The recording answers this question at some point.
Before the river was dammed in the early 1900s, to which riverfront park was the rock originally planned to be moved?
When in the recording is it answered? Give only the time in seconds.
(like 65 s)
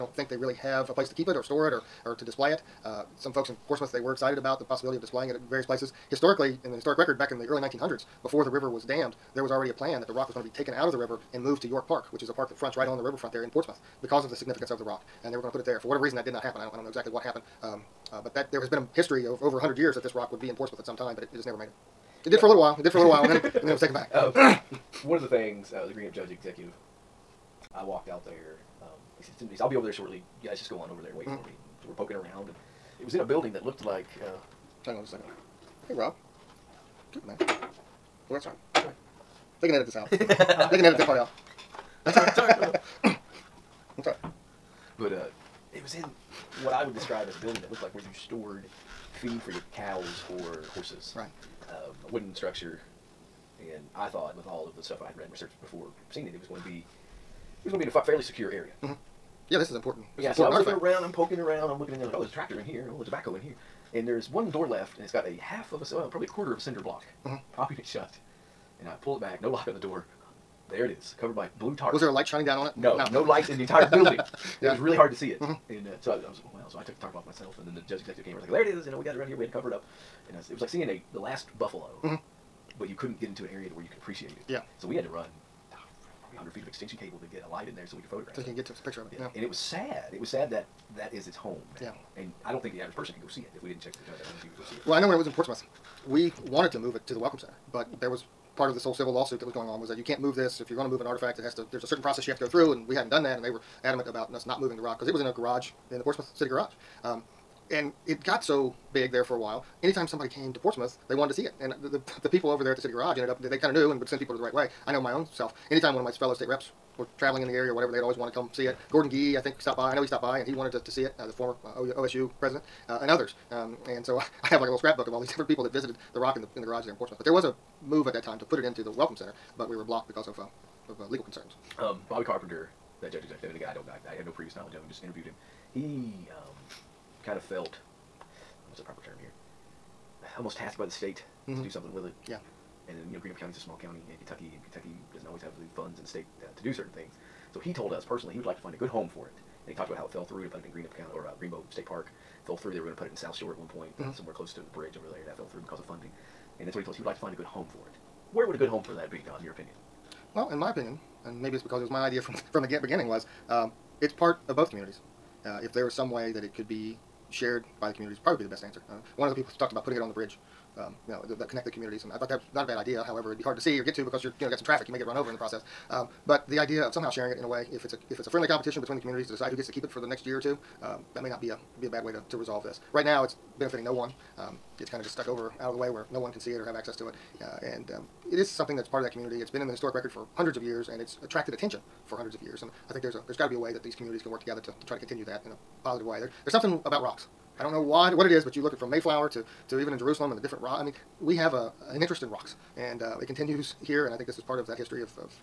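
11 s.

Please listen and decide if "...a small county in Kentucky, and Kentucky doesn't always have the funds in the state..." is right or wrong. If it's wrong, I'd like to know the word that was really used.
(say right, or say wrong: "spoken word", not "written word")
right.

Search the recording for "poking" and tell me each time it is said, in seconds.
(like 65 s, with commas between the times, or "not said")
31 s, 61 s.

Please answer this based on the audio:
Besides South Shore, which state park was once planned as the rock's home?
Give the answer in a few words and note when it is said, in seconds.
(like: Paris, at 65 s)
Greenbo State Park, at 151 s.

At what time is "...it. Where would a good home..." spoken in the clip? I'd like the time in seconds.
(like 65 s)
157 s.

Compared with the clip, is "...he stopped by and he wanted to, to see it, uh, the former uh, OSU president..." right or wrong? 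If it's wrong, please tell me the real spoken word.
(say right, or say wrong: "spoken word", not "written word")
right.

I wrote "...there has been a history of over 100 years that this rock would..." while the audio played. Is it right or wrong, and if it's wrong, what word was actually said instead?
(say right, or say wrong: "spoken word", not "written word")
right.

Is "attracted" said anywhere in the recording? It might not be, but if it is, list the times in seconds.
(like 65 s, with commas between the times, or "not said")
191 s.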